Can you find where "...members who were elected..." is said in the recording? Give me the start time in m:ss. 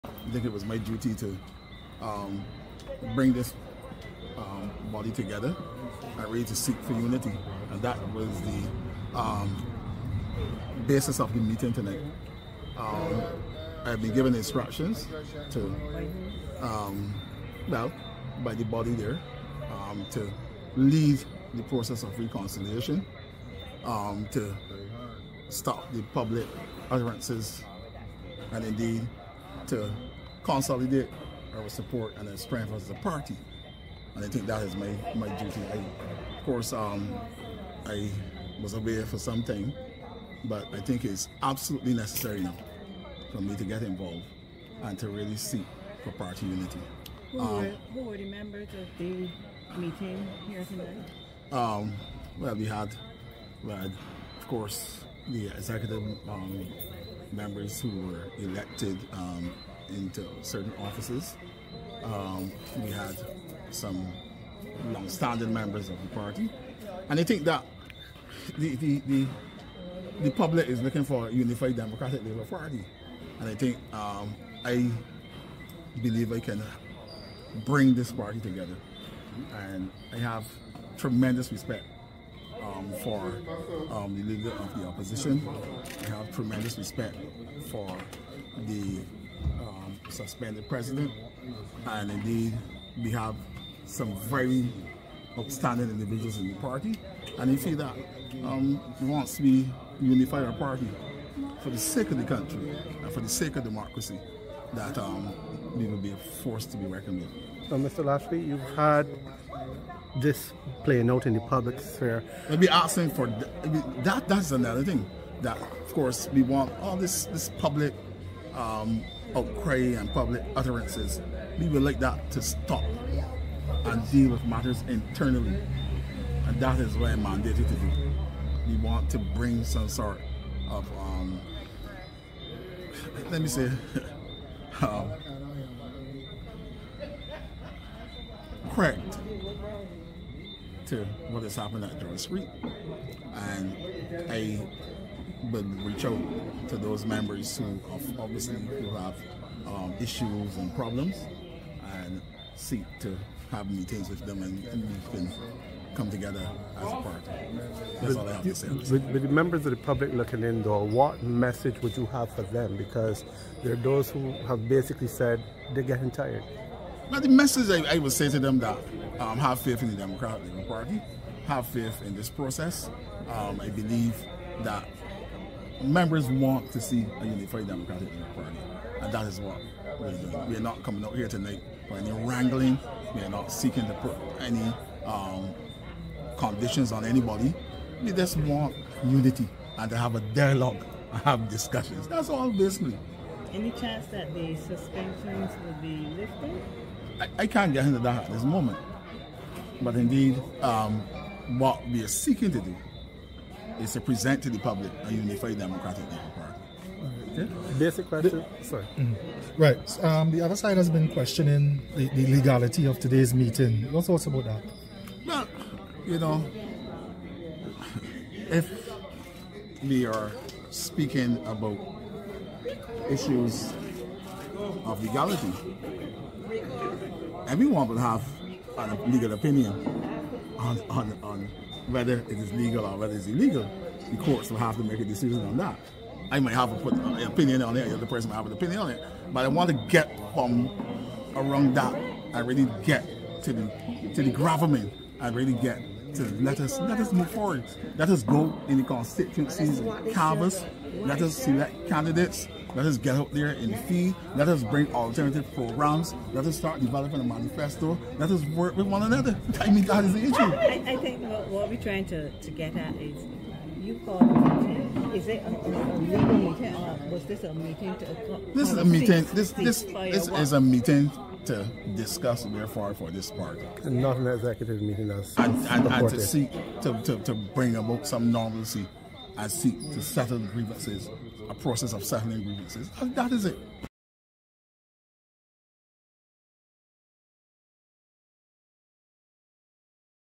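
0:57.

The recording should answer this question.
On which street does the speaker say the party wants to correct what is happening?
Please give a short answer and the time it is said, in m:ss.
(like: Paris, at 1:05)
Dora Street, at 2:21.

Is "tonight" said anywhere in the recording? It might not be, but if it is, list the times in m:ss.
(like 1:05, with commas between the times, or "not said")
0:11, 0:50, 3:01.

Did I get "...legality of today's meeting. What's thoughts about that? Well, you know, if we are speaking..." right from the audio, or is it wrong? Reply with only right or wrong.
right.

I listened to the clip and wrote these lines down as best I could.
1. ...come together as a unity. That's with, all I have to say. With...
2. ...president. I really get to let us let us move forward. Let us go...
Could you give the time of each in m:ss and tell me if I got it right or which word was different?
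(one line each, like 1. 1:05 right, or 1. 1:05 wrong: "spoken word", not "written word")
1. 2:35 wrong: "party", not "unity"
2. 4:04 wrong: "government", not "president".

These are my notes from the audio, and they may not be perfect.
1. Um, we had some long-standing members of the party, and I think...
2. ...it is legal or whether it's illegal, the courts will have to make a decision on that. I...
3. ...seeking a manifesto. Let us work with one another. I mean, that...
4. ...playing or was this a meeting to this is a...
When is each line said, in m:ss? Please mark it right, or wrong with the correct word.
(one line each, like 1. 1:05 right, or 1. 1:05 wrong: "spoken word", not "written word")
1. 1:02 right
2. 3:52 right
3. 4:16 wrong: "developing", not "seeking"
4. 4:26 wrong: "meeting", not "playing".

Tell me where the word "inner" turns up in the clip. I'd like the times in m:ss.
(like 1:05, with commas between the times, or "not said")
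not said.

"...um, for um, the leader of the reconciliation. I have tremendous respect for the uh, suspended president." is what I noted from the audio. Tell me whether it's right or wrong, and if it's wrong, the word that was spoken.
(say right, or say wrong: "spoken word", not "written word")
wrong: "opposition", not "reconciliation".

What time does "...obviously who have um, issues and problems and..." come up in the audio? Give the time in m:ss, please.
2:28.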